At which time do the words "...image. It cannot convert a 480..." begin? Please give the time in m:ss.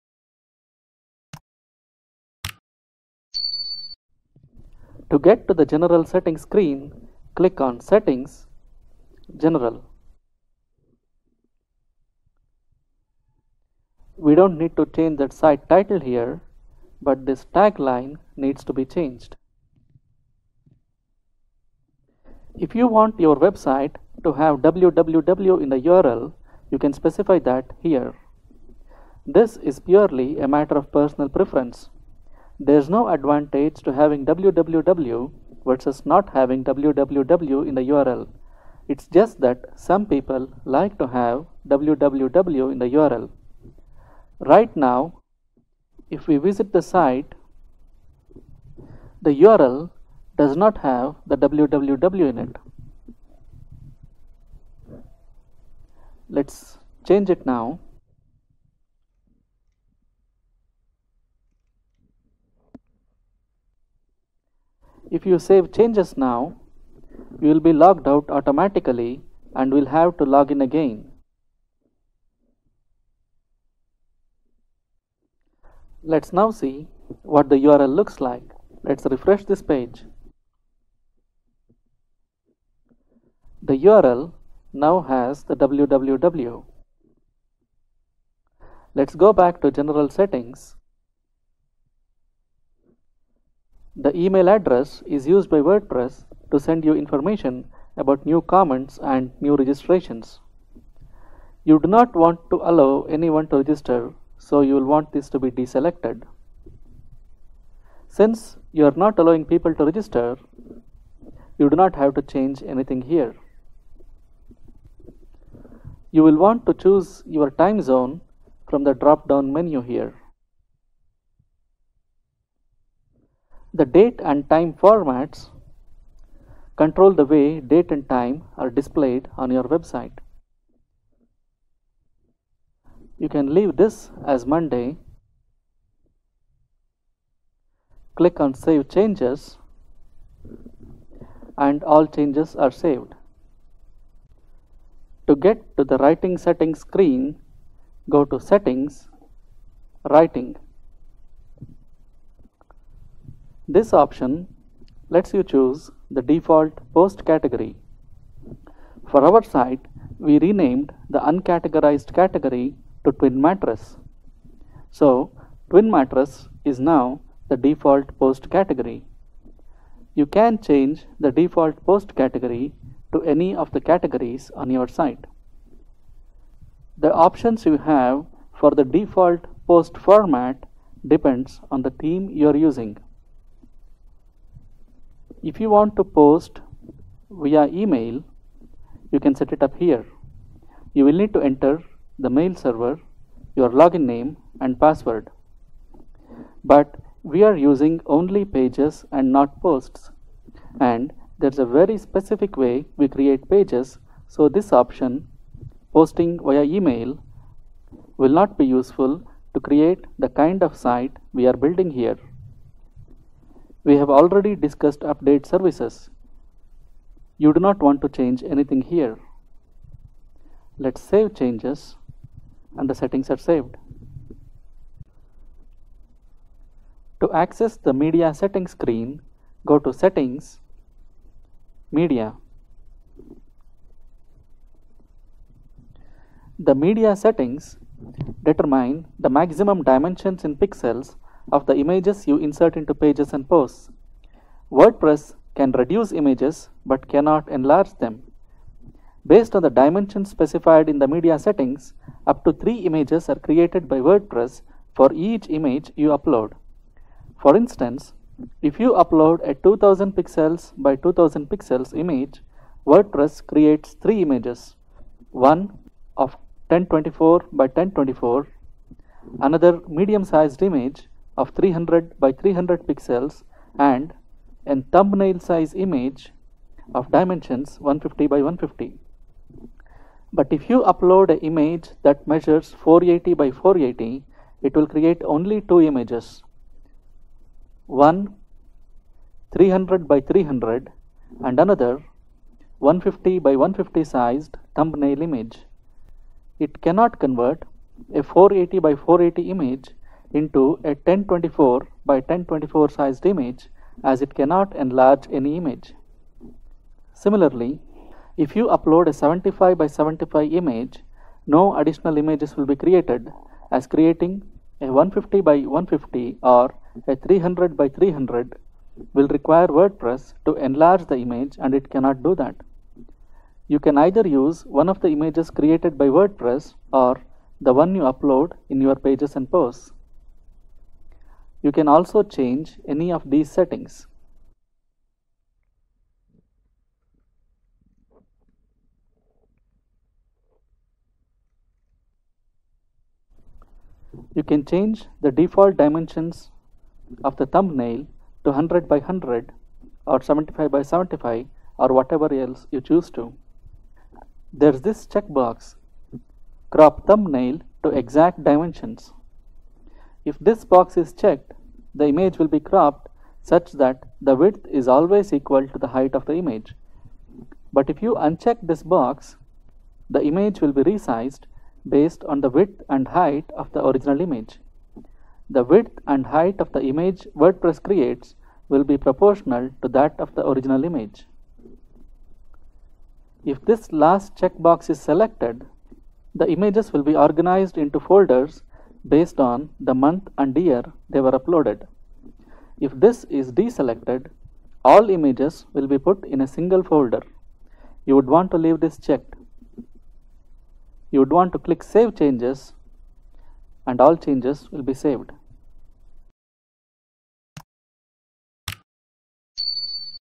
4:55.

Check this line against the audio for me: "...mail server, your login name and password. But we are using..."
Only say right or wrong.
right.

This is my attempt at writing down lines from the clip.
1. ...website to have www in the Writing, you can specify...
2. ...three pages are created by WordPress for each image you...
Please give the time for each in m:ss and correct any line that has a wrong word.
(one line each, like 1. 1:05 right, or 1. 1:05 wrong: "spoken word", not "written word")
1. 0:23 wrong: "URL", not "Writing"
2. 4:12 wrong: "images", not "pages".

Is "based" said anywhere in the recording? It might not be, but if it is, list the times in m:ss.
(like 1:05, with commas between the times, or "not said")
4:09, 6:11, 6:29.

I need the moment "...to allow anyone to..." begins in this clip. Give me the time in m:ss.
1:42.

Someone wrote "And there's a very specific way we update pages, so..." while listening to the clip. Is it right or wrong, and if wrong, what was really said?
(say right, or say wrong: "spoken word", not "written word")
wrong: "create", not "update".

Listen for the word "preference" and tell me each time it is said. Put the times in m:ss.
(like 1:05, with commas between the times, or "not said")
0:31.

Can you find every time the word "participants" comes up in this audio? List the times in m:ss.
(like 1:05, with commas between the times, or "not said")
not said.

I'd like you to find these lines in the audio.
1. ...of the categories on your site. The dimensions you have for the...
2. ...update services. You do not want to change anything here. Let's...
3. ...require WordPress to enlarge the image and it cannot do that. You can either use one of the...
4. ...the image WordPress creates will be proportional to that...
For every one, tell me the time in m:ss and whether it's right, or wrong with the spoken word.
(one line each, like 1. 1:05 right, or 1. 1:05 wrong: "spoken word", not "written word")
1. 2:53 wrong: "options", not "dimensions"
2. 3:34 right
3. 5:19 right
4. 6:16 right.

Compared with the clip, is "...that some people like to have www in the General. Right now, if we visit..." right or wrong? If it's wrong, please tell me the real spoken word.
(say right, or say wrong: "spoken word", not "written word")
wrong: "URL", not "General".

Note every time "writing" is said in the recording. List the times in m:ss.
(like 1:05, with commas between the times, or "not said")
2:25, 2:30.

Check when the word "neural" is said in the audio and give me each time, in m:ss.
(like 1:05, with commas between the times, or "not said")
not said.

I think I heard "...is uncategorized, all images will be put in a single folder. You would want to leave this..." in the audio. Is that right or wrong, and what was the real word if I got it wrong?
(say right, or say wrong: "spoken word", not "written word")
wrong: "deselected", not "uncategorized".